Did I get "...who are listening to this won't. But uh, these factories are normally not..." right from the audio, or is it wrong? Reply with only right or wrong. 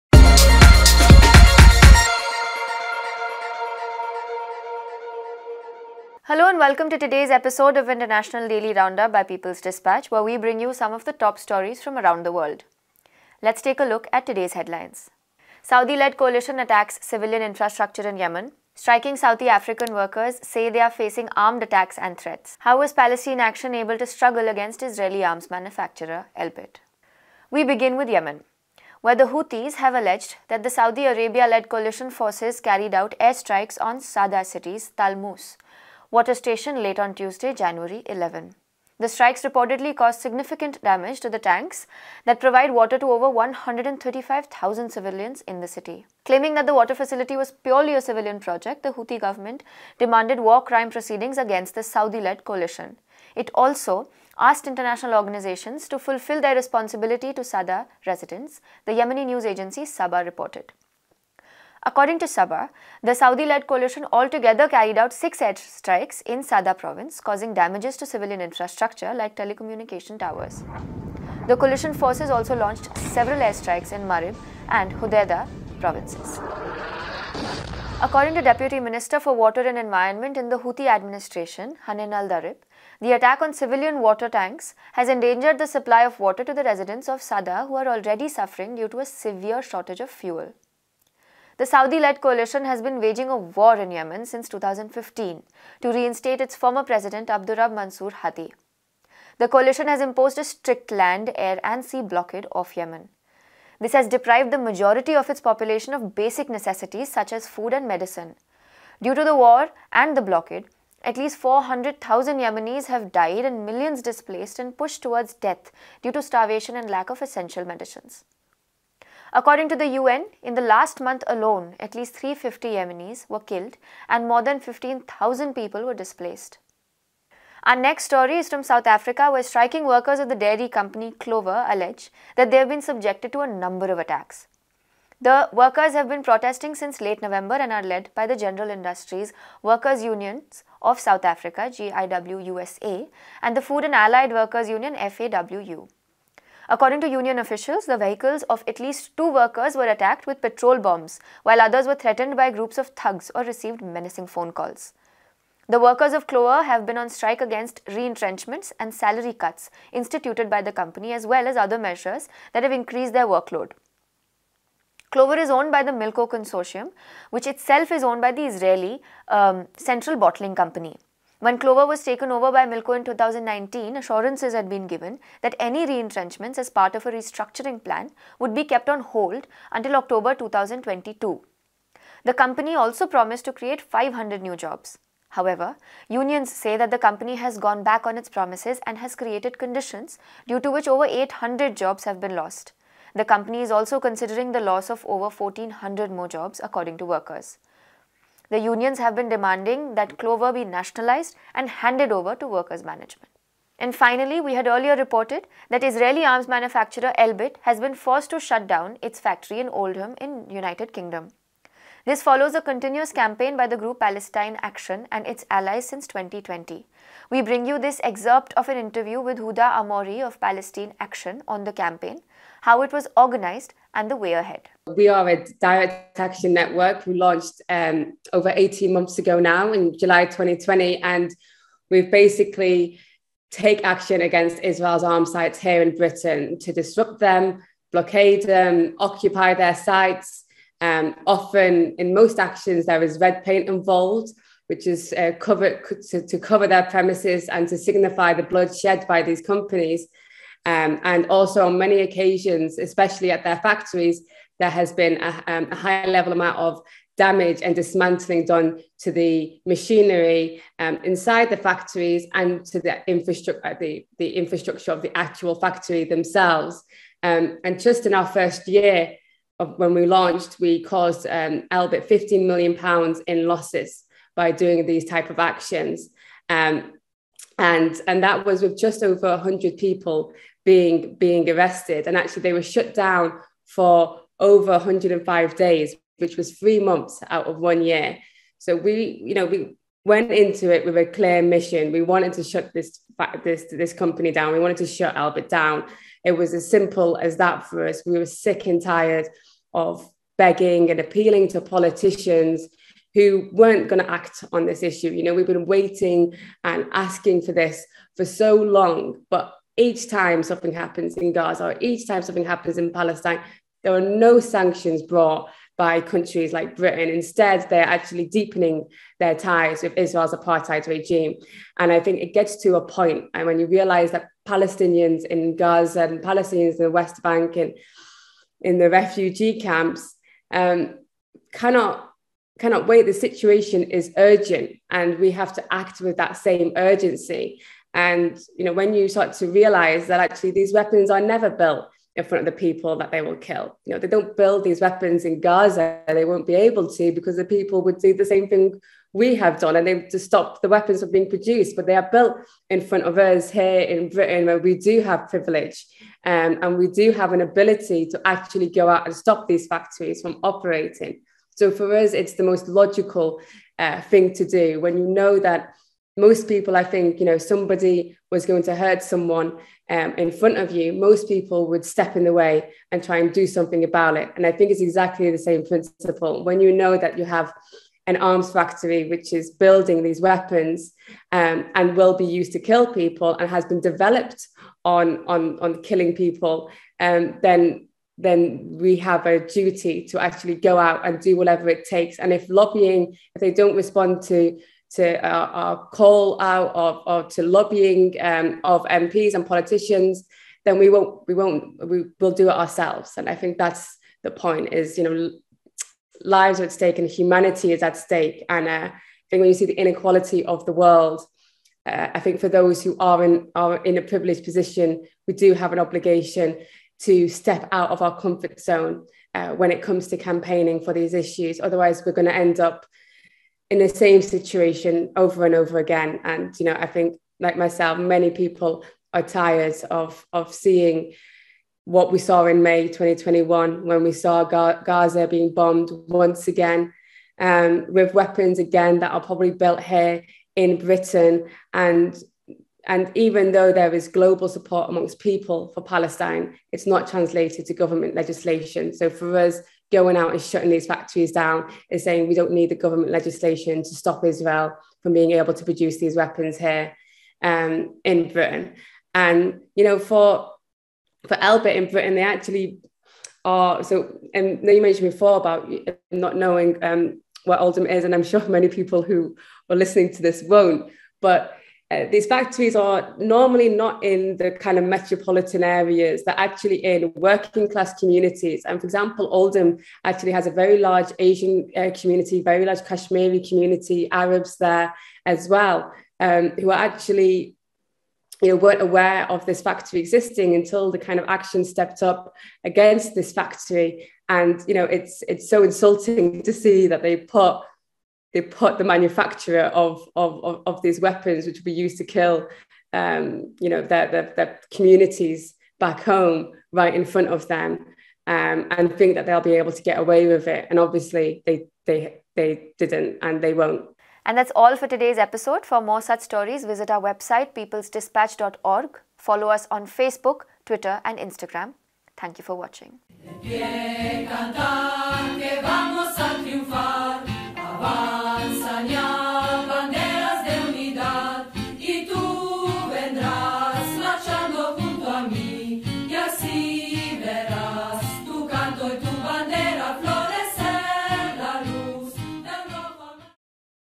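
right.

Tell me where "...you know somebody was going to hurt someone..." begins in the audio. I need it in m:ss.
6:07.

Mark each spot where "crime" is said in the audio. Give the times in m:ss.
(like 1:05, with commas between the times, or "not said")
0:50.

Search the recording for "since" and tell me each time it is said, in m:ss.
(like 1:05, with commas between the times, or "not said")
1:34, 2:16, 3:35.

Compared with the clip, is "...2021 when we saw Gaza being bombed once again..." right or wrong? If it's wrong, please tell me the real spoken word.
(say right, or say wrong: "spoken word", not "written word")
right.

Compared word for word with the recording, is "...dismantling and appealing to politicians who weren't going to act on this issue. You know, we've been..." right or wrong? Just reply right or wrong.
wrong.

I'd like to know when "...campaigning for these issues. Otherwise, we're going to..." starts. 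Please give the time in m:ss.
7:00.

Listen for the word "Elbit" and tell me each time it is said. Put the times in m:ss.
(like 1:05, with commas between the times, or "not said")
0:26, 3:27, 4:31, 4:55, 7:41.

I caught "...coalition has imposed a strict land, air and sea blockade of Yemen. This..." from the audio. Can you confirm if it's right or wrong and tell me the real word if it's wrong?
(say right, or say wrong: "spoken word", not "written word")
right.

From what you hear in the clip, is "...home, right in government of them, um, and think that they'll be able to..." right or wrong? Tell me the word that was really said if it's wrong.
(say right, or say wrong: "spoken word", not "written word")
wrong: "front", not "government".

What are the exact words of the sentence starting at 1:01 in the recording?
According to Saba, the Saudi-led coalition altogether carried out six airstrikes in Sada province, causing damages to civilian infrastructure like telecommunication towers.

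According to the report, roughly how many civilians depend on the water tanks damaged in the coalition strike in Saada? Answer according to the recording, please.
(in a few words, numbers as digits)
135,000.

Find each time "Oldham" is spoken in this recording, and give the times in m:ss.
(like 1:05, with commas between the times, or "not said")
3:29, 7:47, 7:59.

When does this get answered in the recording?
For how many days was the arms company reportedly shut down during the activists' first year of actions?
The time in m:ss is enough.
4:44.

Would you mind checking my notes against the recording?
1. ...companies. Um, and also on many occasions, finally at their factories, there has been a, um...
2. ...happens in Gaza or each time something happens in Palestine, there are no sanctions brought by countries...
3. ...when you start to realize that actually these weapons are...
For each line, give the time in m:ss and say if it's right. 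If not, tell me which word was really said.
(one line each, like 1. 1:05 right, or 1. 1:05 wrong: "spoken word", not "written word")
1. 4:09 wrong: "especially", not "finally"
2. 5:10 right
3. 5:38 right.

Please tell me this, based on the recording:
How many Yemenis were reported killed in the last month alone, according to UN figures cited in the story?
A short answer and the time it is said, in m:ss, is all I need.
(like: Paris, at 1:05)
350, at 2:02.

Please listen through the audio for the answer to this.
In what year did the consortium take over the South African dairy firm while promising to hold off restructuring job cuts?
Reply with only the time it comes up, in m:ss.
2:53.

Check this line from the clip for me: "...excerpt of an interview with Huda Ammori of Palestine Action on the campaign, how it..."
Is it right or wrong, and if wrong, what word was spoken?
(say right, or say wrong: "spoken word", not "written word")
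right.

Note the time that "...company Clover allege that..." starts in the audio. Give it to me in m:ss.
2:10.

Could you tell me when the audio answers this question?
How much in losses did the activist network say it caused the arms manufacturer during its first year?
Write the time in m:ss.
4:32.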